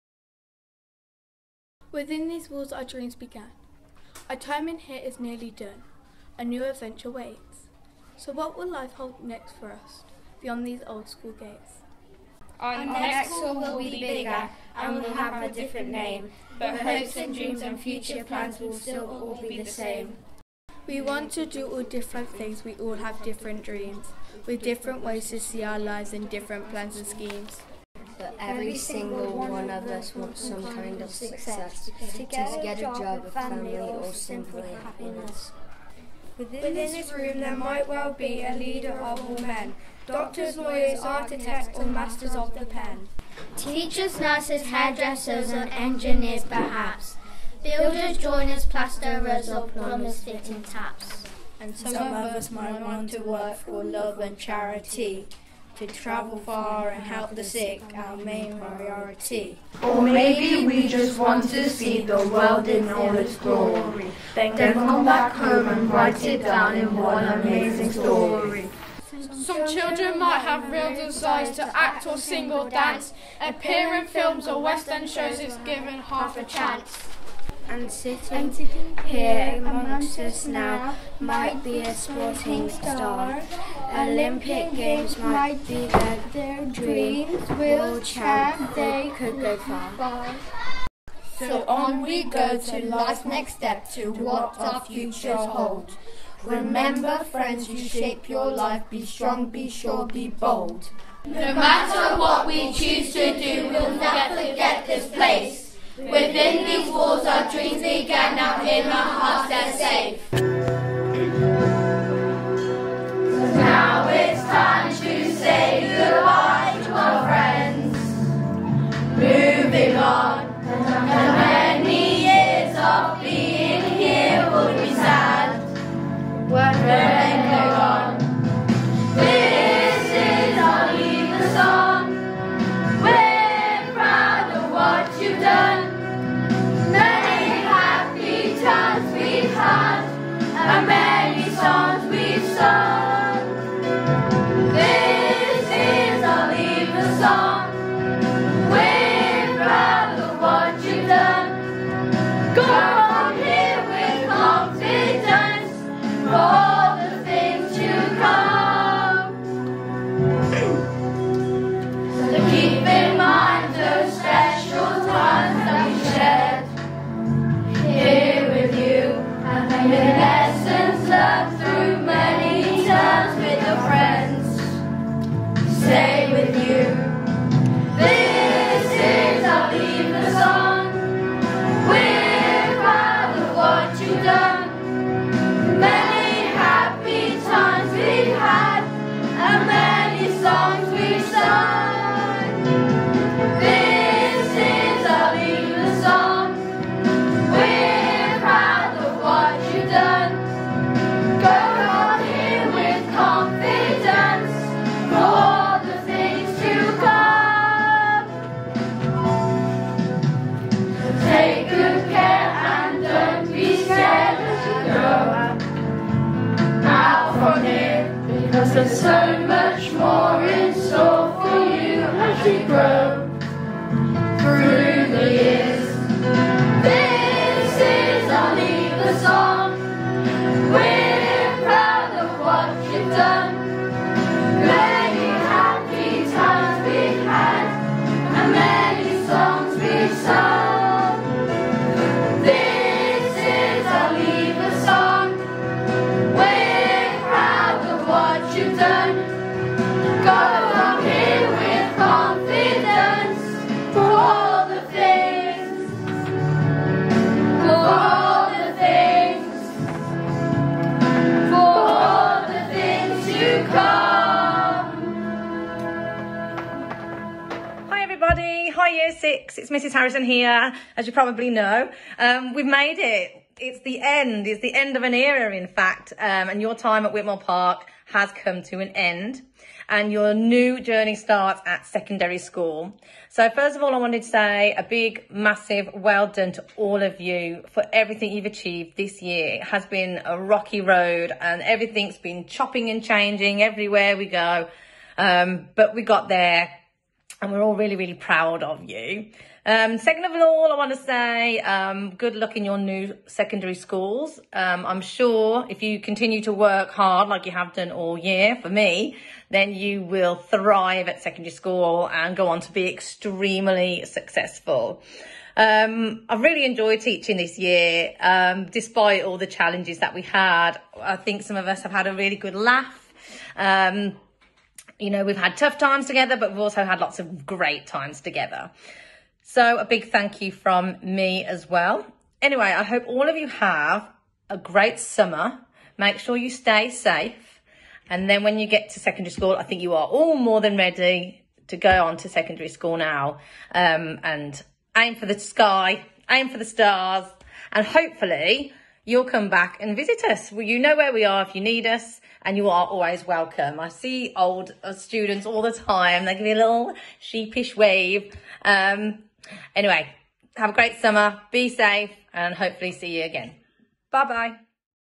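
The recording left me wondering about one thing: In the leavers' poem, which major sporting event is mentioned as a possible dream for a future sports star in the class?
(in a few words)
Olympic Games.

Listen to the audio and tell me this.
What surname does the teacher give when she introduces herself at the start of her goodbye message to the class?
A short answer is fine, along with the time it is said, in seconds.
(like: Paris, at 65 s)
Harrison, at 269 s.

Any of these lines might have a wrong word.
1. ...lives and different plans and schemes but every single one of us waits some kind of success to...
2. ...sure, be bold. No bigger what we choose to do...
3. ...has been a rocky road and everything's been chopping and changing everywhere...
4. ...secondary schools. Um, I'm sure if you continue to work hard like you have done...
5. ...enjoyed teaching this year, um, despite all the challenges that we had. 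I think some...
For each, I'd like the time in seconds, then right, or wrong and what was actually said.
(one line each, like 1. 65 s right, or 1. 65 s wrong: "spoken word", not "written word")
1. 25 s wrong: "wants", not "waits"
2. 99 s wrong: "matter", not "bigger"
3. 289 s right
4. 303 s right
5. 316 s right.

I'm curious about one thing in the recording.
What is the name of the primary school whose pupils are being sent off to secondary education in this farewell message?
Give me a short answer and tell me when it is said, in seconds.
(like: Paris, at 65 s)
Whitmore Park, at 277 s.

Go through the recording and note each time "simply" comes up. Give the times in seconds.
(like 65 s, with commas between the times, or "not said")
34 s.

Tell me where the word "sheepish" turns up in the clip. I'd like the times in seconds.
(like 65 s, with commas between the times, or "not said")
357 s.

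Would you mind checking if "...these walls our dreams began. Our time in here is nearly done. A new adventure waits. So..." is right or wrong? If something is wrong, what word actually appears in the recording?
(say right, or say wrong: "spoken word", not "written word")
right.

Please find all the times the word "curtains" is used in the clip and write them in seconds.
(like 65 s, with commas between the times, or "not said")
not said.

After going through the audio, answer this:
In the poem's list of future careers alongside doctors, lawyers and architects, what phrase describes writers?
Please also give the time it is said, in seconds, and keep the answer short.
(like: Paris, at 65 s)
masters of the pen, at 41 s.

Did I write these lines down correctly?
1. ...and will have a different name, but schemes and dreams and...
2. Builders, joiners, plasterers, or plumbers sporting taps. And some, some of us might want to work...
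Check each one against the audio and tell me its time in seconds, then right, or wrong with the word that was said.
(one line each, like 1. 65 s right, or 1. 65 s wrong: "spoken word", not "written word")
1. 14 s wrong: "hopes", not "schemes"
2. 47 s wrong: "fitting", not "sporting".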